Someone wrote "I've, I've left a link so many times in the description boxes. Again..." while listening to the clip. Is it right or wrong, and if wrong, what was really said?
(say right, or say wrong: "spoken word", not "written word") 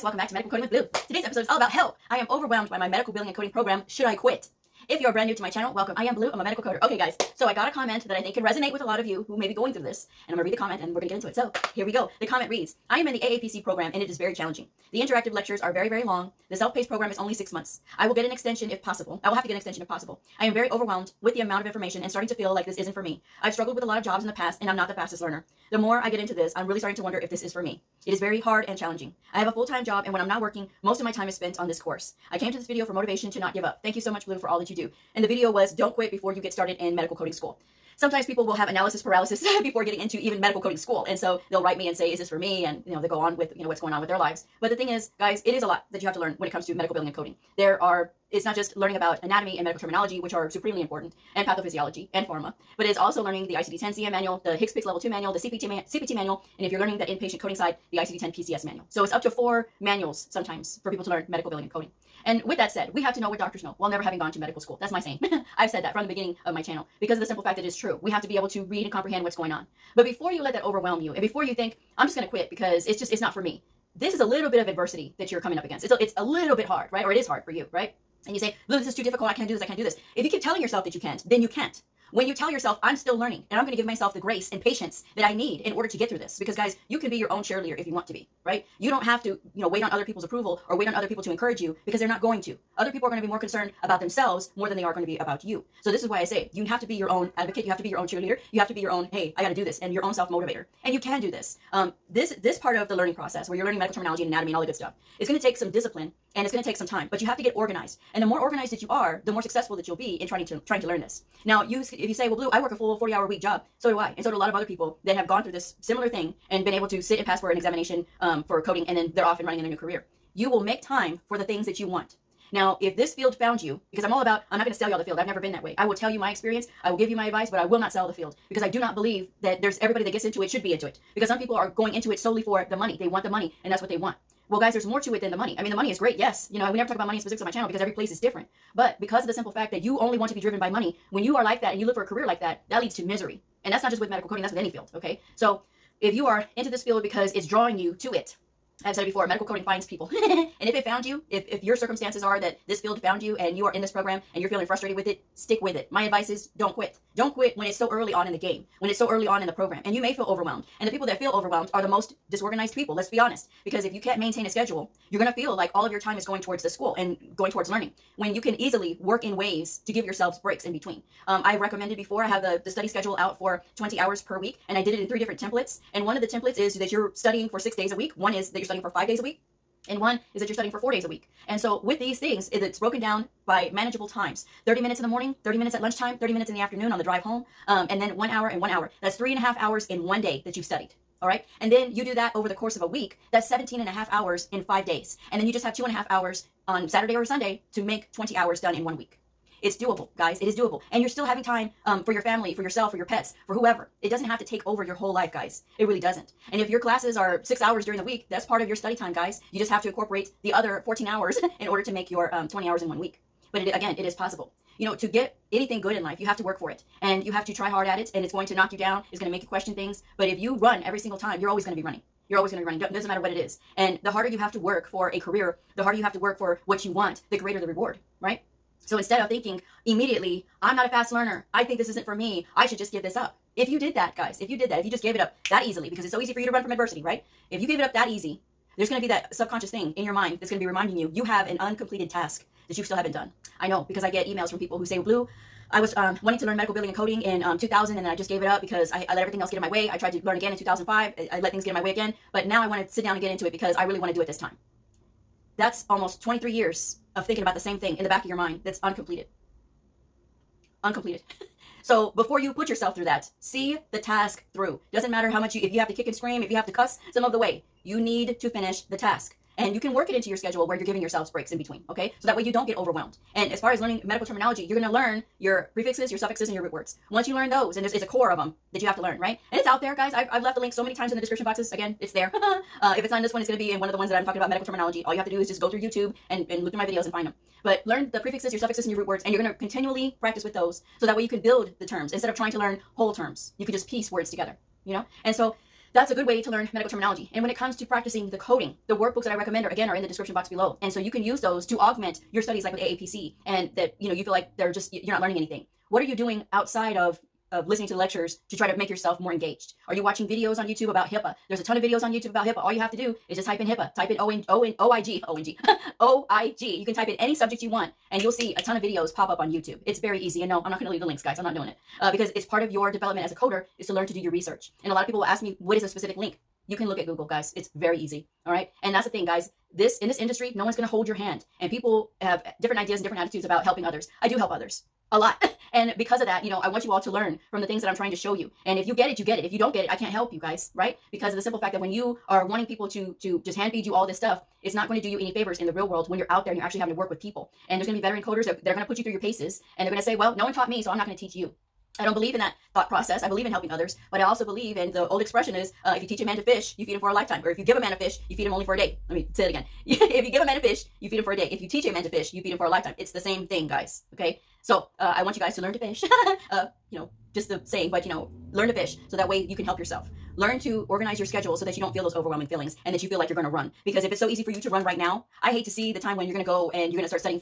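right.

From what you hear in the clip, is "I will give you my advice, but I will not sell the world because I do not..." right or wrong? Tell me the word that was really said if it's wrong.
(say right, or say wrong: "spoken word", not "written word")
wrong: "field", not "world".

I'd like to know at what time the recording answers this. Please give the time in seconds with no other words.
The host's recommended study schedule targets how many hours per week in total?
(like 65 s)
173 s.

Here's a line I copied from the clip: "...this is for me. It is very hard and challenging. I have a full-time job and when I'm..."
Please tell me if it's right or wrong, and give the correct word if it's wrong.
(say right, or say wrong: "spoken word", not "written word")
right.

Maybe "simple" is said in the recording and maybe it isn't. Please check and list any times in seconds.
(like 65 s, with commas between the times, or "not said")
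67 s, 139 s, 341 s.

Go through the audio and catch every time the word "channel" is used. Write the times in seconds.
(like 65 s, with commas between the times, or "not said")
5 s, 66 s, 137 s.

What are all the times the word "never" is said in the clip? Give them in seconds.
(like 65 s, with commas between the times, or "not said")
63 s, 125 s, 136 s.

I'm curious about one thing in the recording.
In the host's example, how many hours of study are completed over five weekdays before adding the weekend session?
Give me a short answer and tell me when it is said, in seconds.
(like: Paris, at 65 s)
17.5, at 193 s.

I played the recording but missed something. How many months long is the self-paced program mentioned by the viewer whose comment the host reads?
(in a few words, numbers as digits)
6.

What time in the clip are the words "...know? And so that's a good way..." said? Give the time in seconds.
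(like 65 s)
294 s.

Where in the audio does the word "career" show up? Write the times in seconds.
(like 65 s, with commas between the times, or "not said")
119 s, 142 s, 225 s.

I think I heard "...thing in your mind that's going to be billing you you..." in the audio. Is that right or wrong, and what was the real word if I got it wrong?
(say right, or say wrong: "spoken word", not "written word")
wrong: "reminding", not "billing".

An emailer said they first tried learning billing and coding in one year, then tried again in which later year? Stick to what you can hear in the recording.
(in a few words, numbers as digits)
2005.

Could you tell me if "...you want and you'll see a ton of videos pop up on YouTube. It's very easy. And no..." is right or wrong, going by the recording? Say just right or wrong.
right.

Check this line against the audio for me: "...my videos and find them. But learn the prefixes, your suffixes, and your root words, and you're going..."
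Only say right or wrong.
right.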